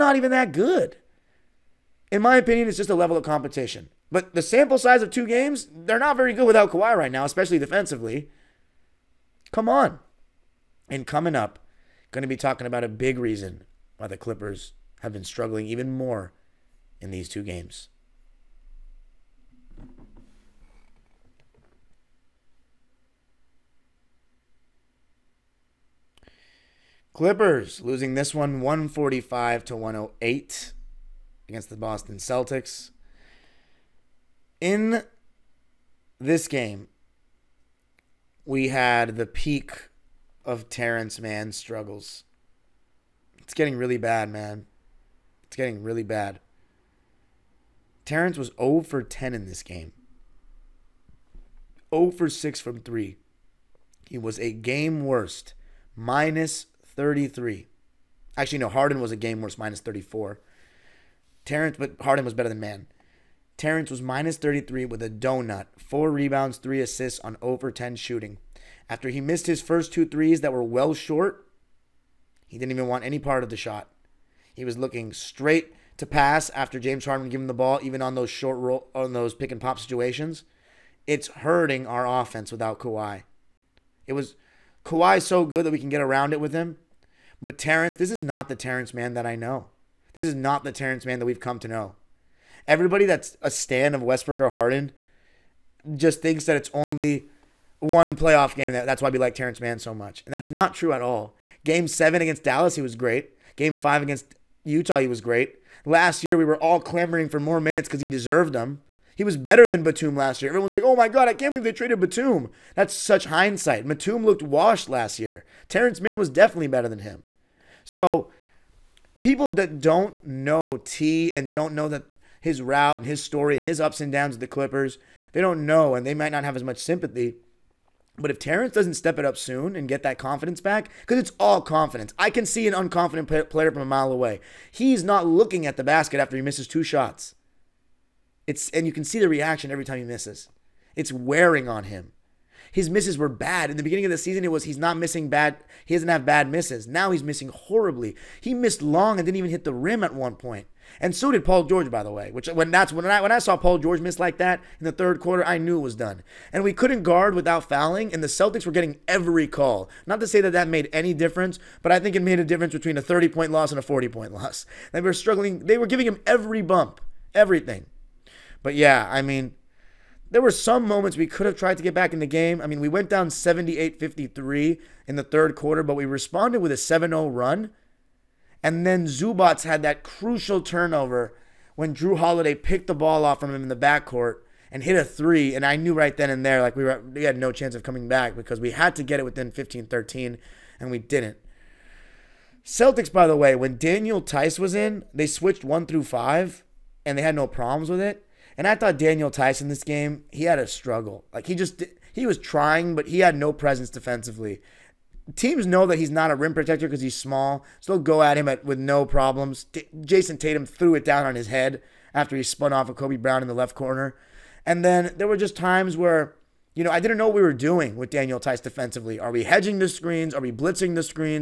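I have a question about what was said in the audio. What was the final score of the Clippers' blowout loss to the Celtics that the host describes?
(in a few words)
145 to 108.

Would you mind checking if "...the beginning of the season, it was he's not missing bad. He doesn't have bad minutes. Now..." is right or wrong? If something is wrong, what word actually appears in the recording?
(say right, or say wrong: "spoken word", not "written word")
wrong: "misses", not "minutes".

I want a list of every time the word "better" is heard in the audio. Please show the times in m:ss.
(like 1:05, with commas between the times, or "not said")
1:02, 1:49, 1:56.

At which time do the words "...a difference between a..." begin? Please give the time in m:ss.
2:42.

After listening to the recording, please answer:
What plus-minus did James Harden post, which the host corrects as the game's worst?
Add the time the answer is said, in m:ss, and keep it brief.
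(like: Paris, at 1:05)
minus 34, at 0:59.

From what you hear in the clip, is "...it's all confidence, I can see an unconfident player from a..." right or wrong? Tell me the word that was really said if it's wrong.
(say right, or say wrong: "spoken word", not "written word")
right.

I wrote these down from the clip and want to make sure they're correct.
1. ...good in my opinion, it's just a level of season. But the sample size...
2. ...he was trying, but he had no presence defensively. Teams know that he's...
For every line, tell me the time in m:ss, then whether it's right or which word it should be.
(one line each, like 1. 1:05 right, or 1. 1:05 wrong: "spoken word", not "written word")
1. 0:00 wrong: "competition", not "season"
2. 3:22 right.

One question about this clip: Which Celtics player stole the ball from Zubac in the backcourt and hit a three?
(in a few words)
Jrue Holiday.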